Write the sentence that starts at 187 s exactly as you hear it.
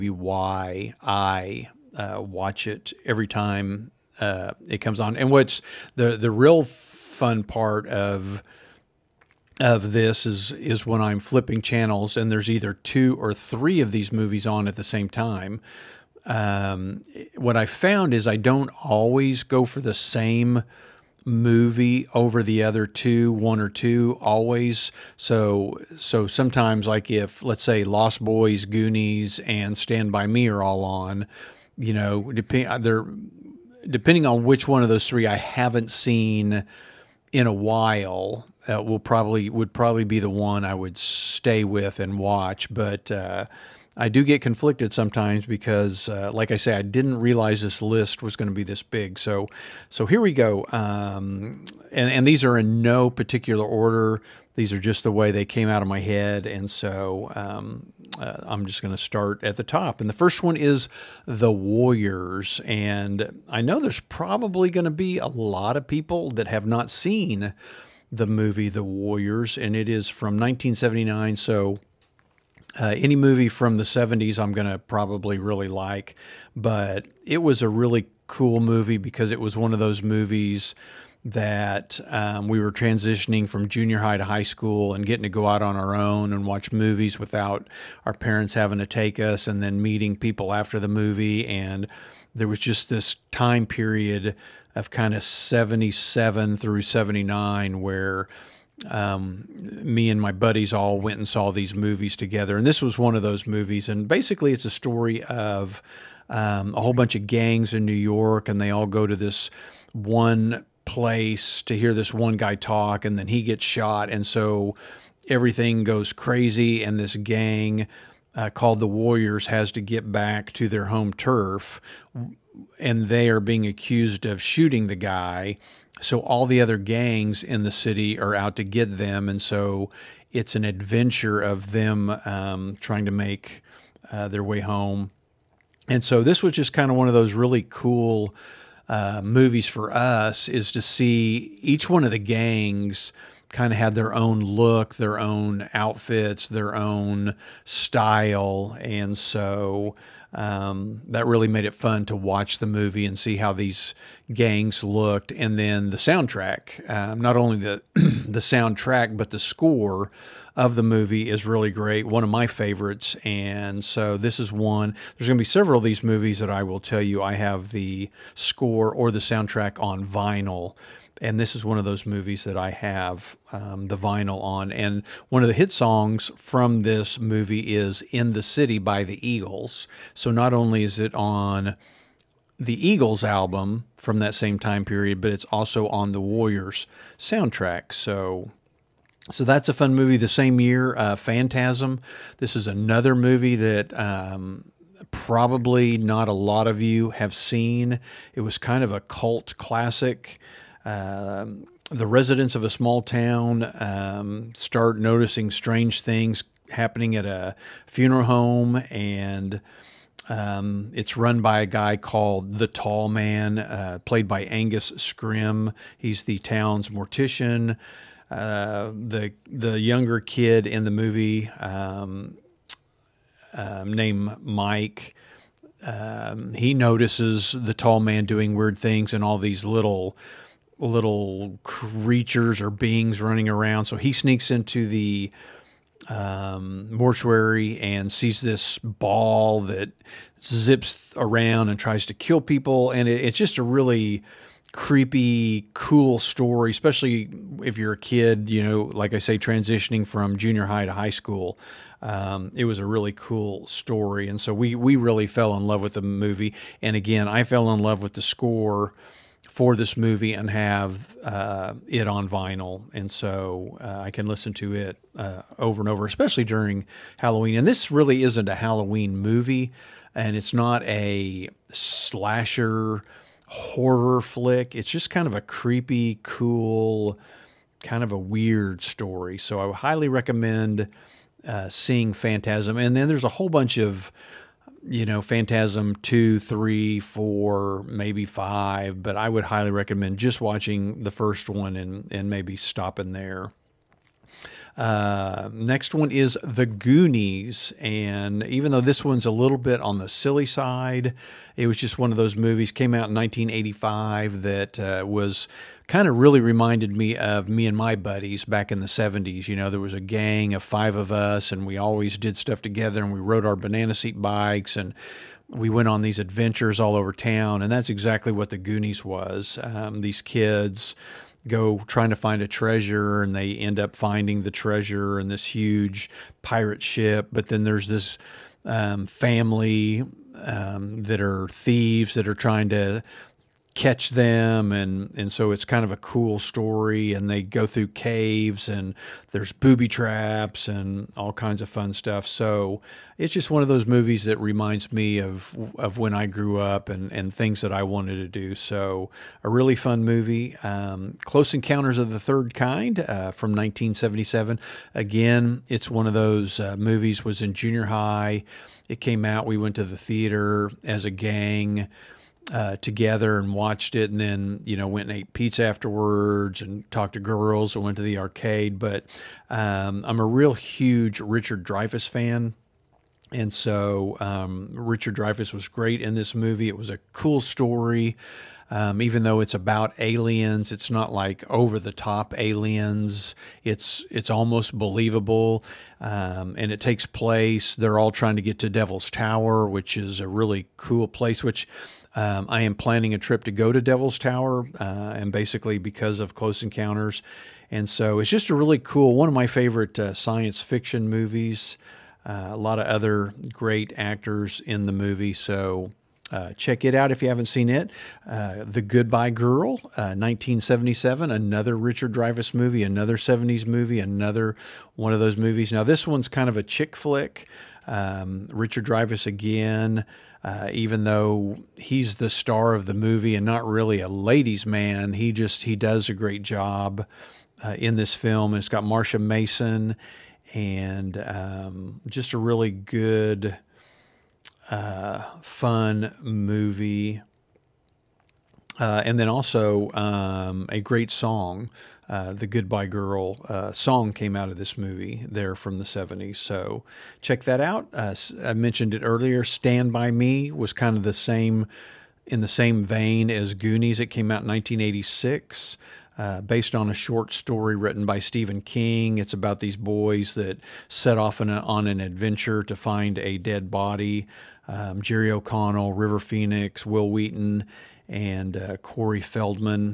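So so that's a fun movie.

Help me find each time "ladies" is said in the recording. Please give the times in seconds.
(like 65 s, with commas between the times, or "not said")
424 s.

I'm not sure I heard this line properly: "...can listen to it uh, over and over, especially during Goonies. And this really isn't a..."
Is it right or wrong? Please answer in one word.
wrong.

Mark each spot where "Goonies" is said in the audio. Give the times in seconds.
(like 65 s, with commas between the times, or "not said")
28 s, 296 s, 318 s, 453 s.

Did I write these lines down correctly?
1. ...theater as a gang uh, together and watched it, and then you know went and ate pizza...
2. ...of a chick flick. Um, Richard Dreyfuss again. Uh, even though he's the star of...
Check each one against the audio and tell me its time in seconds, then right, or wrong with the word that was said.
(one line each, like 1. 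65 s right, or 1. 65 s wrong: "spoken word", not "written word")
1. 359 s right
2. 416 s right.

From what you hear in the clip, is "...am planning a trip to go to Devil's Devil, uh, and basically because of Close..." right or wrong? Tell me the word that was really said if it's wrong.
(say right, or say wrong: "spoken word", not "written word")
wrong: "Tower", not "Devil".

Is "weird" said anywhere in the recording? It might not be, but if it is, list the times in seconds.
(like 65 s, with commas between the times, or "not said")
228 s, 278 s.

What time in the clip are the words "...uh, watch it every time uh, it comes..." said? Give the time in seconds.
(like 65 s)
1 s.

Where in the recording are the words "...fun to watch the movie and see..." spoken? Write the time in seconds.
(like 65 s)
151 s.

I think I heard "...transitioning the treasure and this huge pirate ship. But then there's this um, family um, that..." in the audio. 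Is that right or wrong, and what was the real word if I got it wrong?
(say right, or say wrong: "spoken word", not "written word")
wrong: "finding", not "transitioning".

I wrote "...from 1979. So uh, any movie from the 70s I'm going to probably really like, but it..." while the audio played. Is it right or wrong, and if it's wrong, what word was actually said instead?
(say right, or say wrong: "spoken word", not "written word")
right.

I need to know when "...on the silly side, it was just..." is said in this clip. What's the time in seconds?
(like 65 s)
299 s.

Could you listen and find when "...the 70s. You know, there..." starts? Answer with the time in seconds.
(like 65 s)
308 s.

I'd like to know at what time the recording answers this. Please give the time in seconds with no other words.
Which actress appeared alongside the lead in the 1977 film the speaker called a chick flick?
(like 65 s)
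428 s.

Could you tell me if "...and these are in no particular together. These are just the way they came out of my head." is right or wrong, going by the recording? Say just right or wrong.
wrong.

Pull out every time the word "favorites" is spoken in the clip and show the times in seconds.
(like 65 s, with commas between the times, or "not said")
162 s, 399 s.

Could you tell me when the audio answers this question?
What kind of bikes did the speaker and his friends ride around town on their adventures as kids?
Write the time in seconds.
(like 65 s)
313 s.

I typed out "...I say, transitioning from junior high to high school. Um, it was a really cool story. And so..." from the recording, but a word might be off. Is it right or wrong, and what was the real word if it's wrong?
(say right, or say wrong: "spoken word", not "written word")
right.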